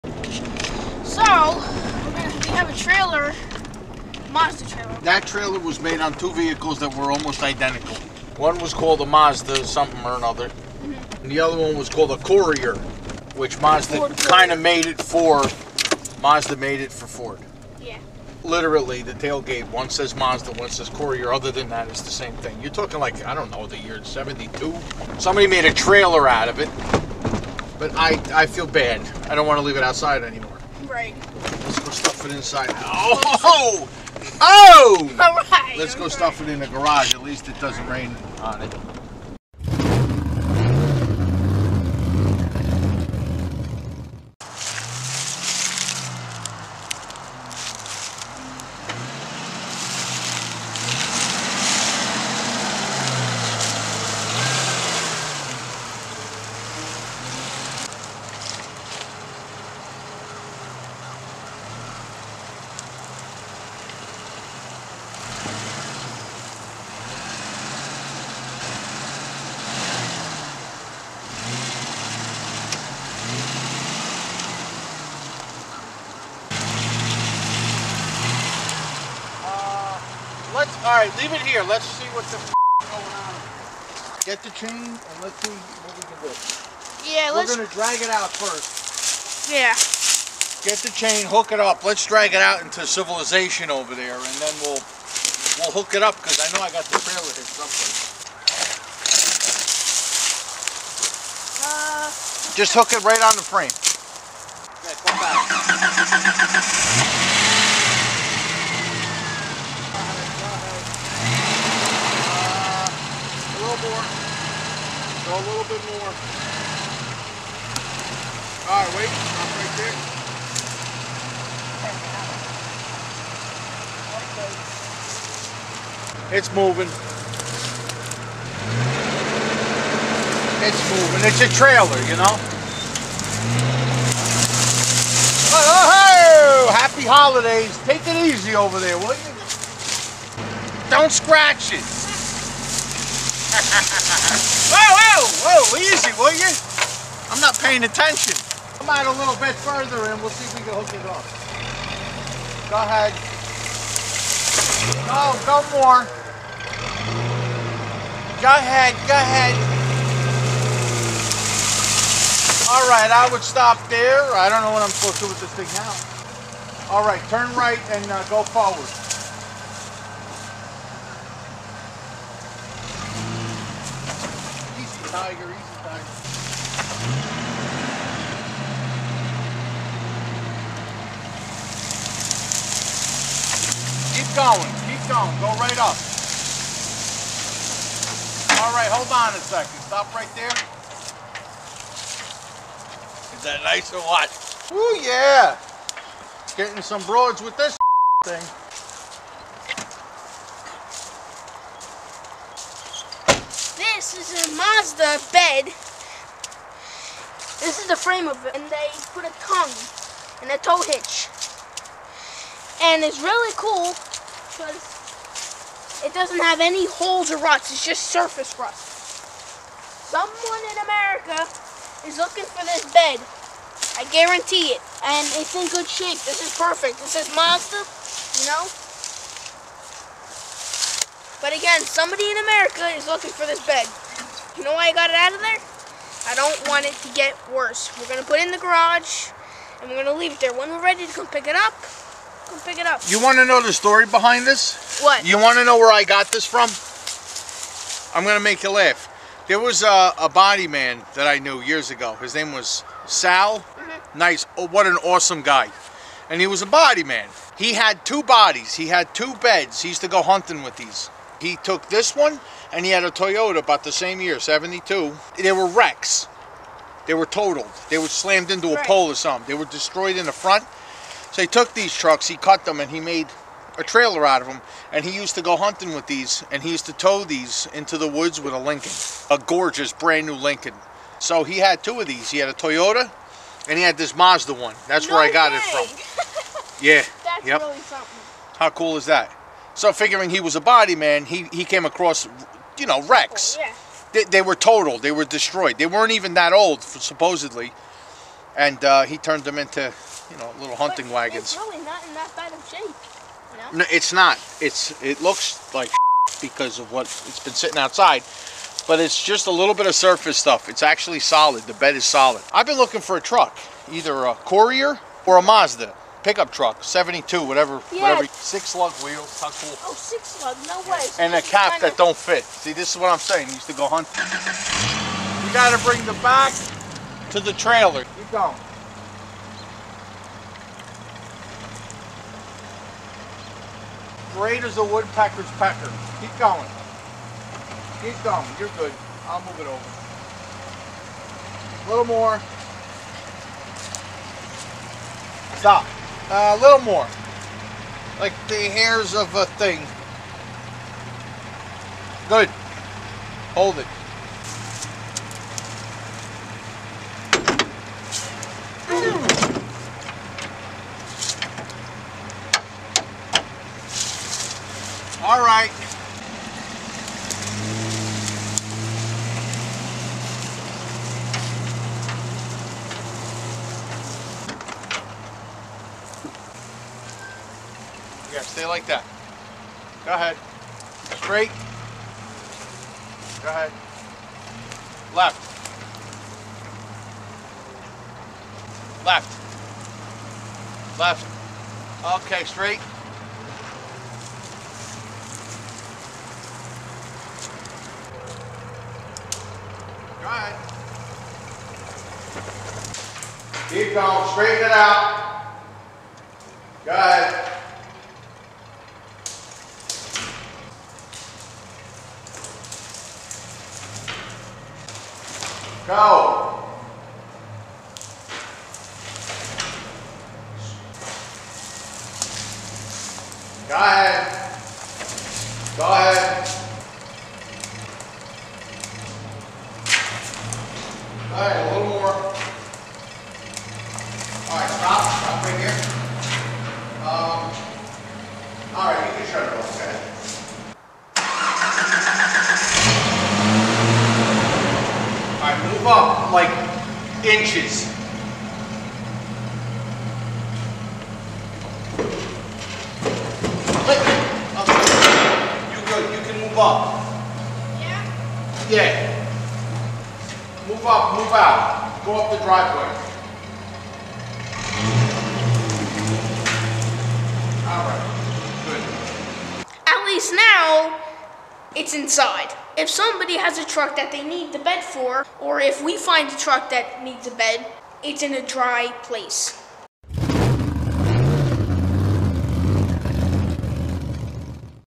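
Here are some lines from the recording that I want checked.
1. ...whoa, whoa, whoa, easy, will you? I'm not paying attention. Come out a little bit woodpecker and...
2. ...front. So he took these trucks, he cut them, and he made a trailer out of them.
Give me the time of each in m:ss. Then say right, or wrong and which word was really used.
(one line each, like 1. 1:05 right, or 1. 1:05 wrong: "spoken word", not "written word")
1. 2:23 wrong: "further", not "woodpecker"
2. 4:30 right.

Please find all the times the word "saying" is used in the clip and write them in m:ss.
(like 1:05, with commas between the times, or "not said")
5:23.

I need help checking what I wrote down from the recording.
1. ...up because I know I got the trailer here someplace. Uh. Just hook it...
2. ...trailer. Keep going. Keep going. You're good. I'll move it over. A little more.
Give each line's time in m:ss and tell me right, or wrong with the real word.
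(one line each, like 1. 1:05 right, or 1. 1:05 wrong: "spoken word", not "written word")
1. 1:36 right
2. 5:35 wrong: "pecker", not "trailer".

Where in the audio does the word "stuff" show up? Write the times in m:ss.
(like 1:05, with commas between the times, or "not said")
0:31, 0:36, 5:10.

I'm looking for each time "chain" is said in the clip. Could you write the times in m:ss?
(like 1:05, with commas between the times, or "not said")
1:24, 1:30.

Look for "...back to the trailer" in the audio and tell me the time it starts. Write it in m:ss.
5:26.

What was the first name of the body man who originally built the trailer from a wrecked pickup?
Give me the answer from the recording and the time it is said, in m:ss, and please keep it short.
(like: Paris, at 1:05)
Sal, at 4:13.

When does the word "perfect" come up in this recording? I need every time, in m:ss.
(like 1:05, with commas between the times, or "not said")
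3:46.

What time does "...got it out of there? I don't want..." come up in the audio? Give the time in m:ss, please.
3:54.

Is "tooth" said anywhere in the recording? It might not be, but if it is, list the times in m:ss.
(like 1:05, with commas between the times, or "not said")
not said.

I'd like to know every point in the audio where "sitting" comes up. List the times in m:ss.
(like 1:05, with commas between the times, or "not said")
5:07.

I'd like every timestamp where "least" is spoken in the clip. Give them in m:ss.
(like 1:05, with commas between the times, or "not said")
0:37, 7:50.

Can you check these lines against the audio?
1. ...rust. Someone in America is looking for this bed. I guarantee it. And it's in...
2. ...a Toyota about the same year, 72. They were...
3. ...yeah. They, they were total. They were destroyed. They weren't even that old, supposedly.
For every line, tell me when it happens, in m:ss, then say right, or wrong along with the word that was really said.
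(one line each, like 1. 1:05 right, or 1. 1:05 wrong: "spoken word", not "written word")
1. 3:38 right
2. 4:23 right
3. 4:53 right.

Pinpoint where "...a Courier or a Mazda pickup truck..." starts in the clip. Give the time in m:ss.
5:14.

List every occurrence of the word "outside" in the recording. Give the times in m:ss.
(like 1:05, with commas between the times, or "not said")
0:29, 5:07.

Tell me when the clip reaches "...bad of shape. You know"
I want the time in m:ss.
5:02.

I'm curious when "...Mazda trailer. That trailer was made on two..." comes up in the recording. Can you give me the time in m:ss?
0:04.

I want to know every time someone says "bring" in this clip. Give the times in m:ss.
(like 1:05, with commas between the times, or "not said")
5:25.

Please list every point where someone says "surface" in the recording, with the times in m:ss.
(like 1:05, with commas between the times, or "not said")
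3:38, 5:09.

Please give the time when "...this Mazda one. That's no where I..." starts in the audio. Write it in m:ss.
4:43.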